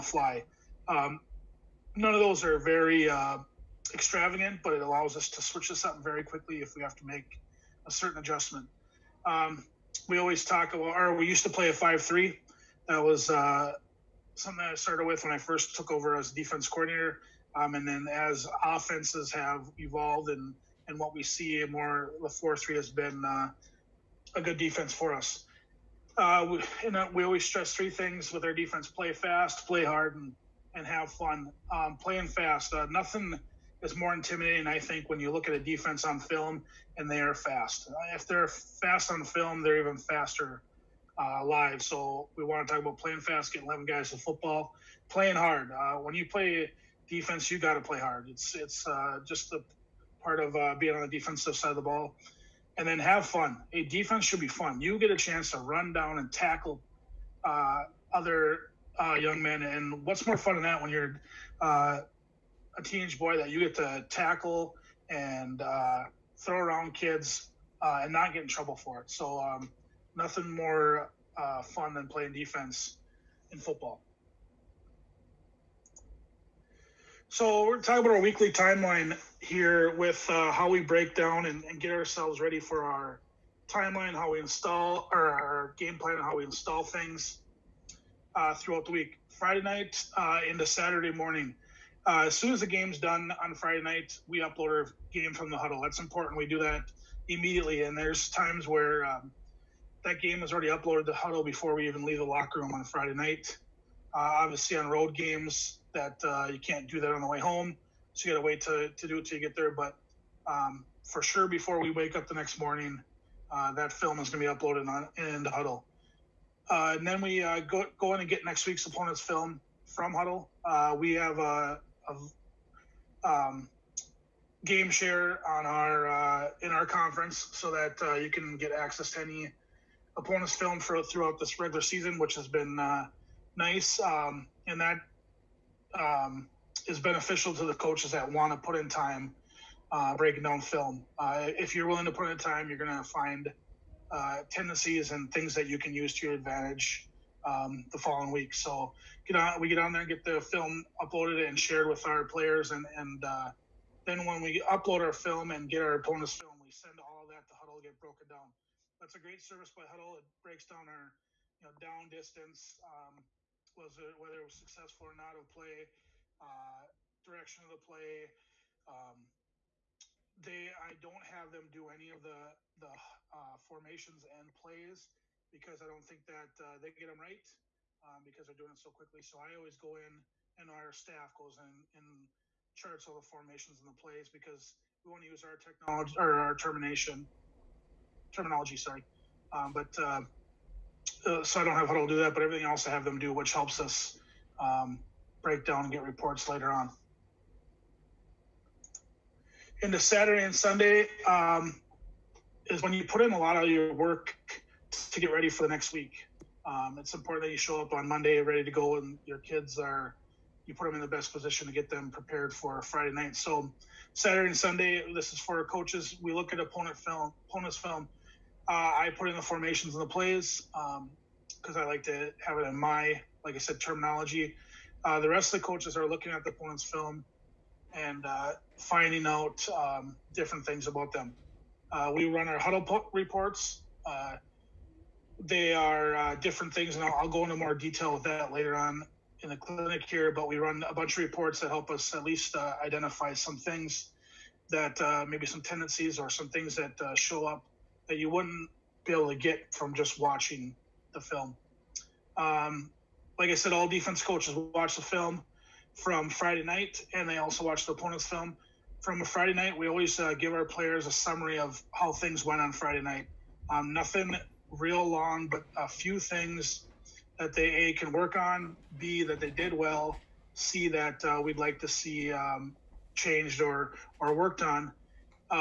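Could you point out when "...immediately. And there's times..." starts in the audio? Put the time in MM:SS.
01:37.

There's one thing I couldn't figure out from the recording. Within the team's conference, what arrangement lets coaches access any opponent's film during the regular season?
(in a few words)
game share.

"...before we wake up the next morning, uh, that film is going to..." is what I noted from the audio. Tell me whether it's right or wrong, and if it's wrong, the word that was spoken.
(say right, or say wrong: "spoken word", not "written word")
right.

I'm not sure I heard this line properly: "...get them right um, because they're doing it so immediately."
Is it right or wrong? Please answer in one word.
wrong.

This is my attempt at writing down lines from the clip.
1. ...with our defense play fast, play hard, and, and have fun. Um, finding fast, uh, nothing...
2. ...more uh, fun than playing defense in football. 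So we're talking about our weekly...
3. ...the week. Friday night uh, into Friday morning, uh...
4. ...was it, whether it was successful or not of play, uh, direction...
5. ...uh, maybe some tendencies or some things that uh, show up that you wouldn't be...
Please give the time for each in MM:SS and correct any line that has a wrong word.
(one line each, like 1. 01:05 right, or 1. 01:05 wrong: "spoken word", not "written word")
1. 00:28 wrong: "playing", not "finding"
2. 01:10 right
3. 01:28 wrong: "Saturday", not "Friday"
4. 02:43 right
5. 04:04 right.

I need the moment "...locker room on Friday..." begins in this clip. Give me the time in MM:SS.
01:42.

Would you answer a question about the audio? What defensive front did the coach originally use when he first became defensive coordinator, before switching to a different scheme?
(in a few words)
5-3.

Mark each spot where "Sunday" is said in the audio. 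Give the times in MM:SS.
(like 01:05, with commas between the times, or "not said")
03:20, 03:34.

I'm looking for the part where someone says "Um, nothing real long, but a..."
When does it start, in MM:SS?
04:23.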